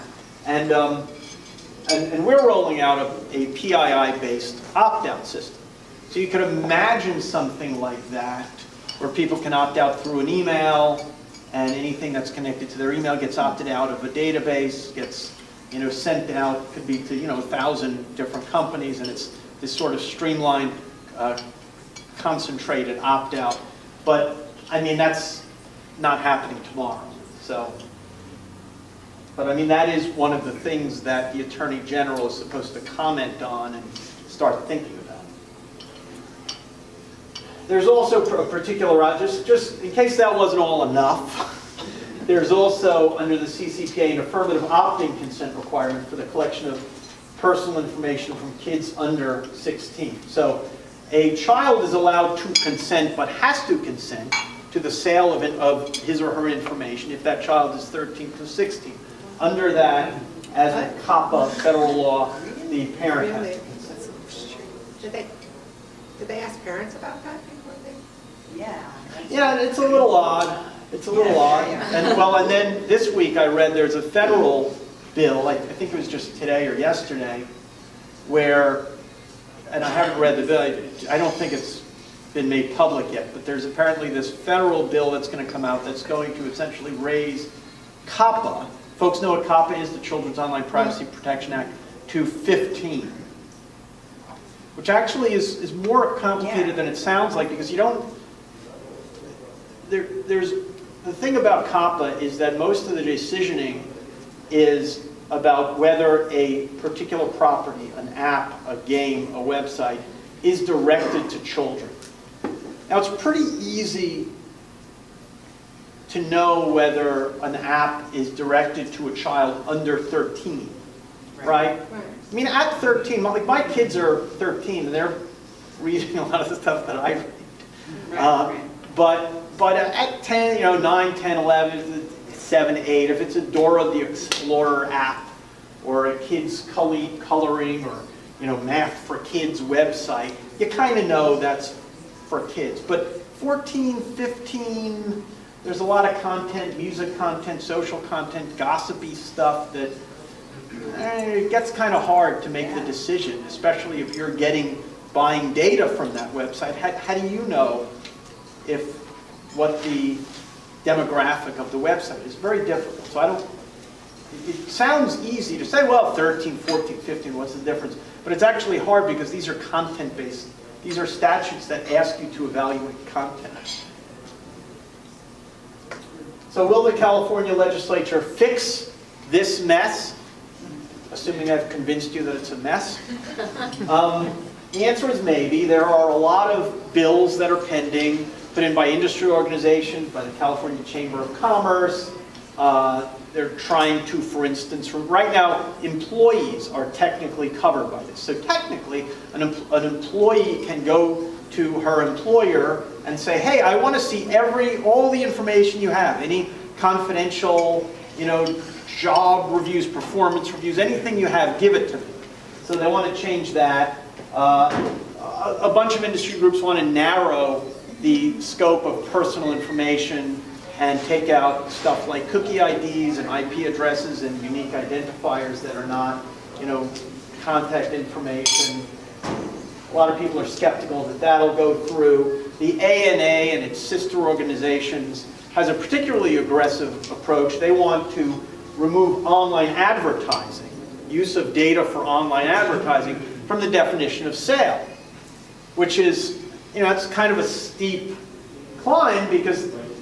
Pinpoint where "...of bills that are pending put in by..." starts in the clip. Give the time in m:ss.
3:06.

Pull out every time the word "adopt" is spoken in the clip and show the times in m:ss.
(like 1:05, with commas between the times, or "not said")
not said.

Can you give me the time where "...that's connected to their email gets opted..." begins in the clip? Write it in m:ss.
0:12.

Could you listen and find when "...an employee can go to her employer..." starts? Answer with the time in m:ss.
3:19.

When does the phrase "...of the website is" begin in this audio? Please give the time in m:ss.
2:41.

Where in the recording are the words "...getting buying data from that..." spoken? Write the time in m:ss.
2:34.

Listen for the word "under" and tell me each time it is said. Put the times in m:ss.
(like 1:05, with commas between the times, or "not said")
0:43, 0:48, 0:59, 1:59.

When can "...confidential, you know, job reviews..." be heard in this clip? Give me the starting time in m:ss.
3:26.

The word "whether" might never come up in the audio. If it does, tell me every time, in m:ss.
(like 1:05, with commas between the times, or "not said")
1:45, 1:56.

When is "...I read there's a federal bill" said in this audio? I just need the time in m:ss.
1:13.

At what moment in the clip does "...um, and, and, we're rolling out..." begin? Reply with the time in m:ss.
0:00.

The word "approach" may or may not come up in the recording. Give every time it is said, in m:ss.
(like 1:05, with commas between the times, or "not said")
3:57.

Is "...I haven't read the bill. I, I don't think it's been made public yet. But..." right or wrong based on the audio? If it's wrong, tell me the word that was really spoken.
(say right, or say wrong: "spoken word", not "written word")
right.